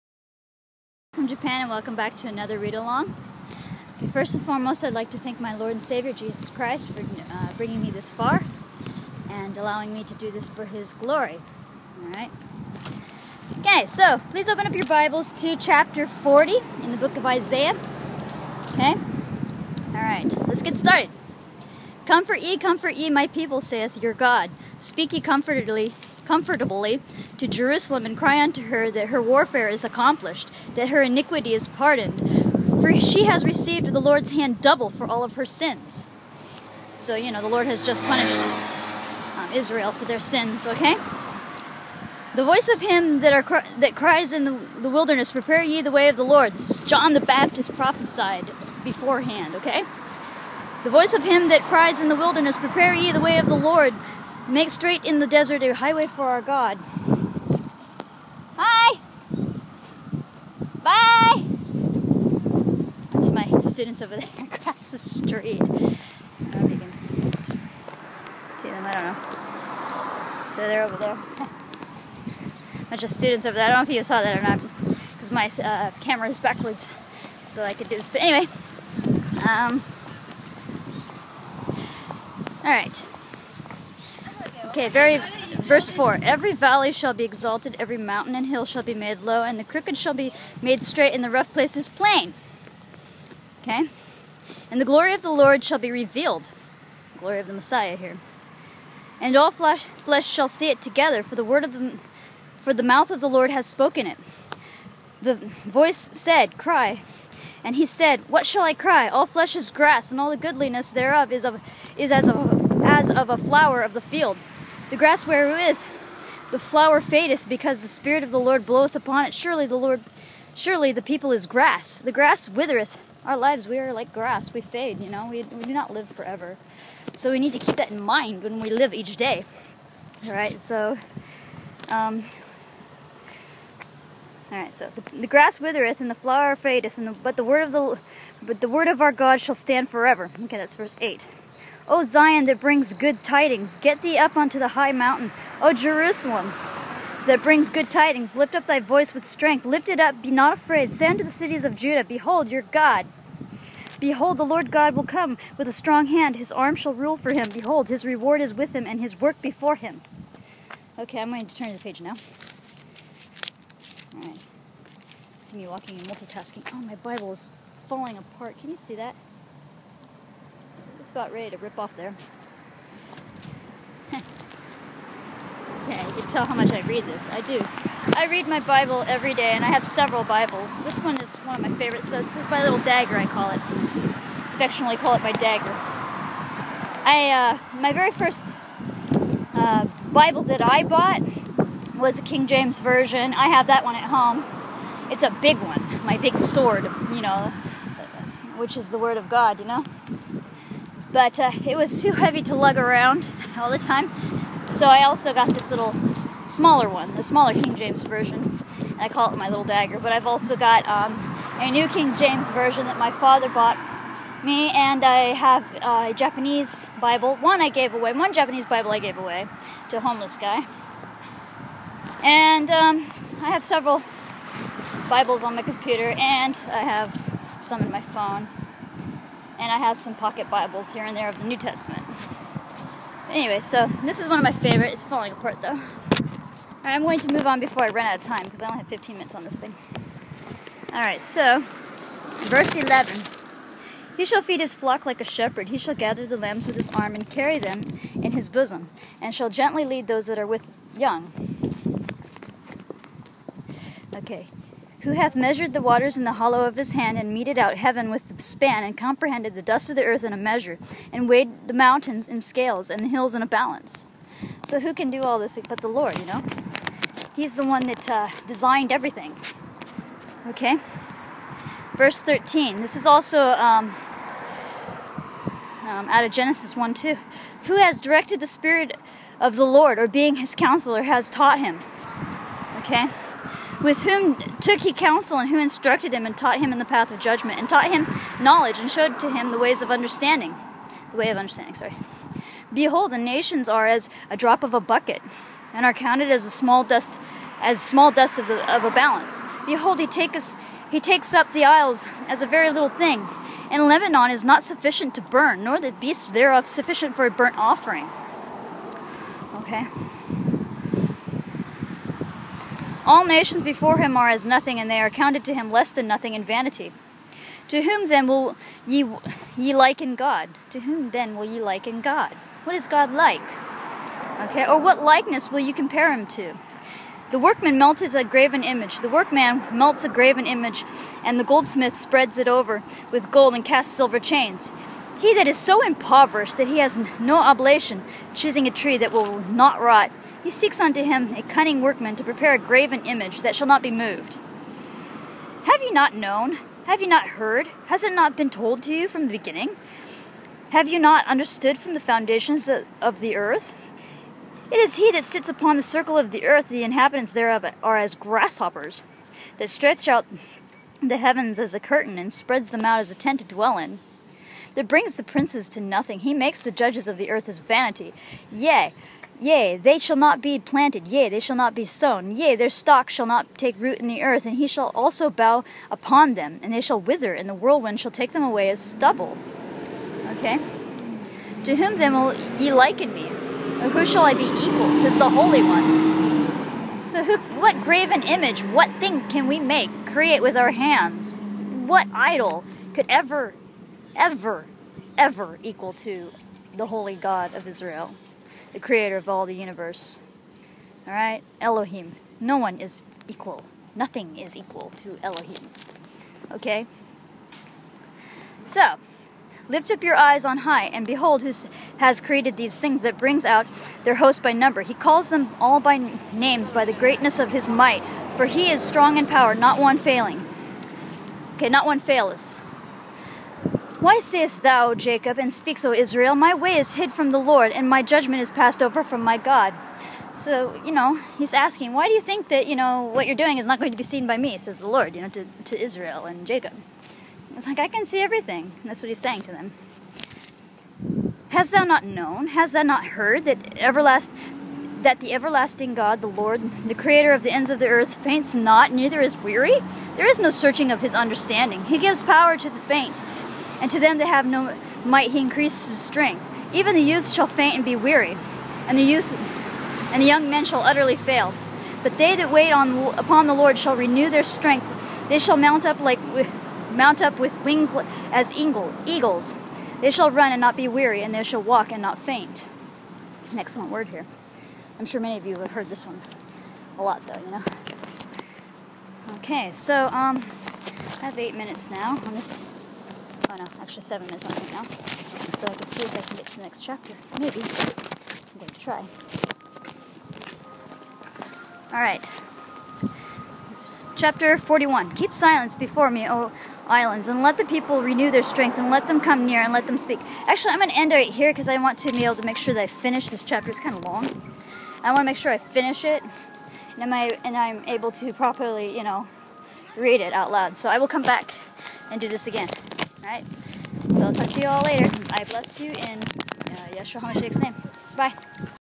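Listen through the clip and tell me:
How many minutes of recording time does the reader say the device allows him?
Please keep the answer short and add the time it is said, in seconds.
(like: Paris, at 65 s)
15, at 238 s.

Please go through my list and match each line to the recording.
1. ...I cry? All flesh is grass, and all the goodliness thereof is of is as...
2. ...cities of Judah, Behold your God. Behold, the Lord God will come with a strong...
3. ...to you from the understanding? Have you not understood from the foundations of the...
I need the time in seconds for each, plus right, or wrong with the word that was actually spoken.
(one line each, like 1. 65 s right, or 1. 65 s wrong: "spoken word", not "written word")
1. 108 s right
2. 151 s right
3. 348 s wrong: "beginning", not "understanding".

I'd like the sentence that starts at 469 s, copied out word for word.
They shall run and not be weary, and they shall walk and not faint.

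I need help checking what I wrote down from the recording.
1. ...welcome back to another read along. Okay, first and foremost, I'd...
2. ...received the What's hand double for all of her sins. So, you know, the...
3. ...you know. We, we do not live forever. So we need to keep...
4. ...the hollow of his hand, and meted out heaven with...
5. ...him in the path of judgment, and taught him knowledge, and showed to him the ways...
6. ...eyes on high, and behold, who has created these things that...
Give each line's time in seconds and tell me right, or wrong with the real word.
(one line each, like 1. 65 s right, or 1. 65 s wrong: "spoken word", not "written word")
1. 1 s right
2. 33 s wrong: "Lord", not "What"
3. 124 s right
4. 256 s right
5. 286 s right
6. 410 s right.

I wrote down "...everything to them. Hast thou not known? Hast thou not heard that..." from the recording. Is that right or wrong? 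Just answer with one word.
wrong.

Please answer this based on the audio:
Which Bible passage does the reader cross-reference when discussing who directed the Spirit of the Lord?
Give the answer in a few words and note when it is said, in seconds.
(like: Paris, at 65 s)
Genesis 1:2, at 276 s.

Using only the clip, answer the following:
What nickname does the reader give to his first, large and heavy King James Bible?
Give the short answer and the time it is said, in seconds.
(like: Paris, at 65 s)
my big sword, at 196 s.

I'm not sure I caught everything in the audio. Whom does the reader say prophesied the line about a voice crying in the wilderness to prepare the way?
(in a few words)
John the Baptist.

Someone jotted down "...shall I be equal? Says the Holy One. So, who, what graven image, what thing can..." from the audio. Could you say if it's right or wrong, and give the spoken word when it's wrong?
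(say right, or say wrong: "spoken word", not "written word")
right.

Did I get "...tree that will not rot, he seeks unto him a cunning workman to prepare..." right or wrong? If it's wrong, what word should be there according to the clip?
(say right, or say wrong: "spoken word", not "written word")
right.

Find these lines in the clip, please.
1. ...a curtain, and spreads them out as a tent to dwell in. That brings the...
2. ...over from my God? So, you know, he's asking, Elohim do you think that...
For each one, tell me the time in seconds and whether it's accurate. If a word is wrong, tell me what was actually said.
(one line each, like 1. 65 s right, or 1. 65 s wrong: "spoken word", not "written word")
1. 361 s right
2. 428 s wrong: "Why", not "Elohim".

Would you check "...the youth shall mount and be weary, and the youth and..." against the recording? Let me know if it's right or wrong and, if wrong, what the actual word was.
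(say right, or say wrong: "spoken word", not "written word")
wrong: "faint", not "mount".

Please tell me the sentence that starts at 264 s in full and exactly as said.
So who can do all this but the Lord, you know?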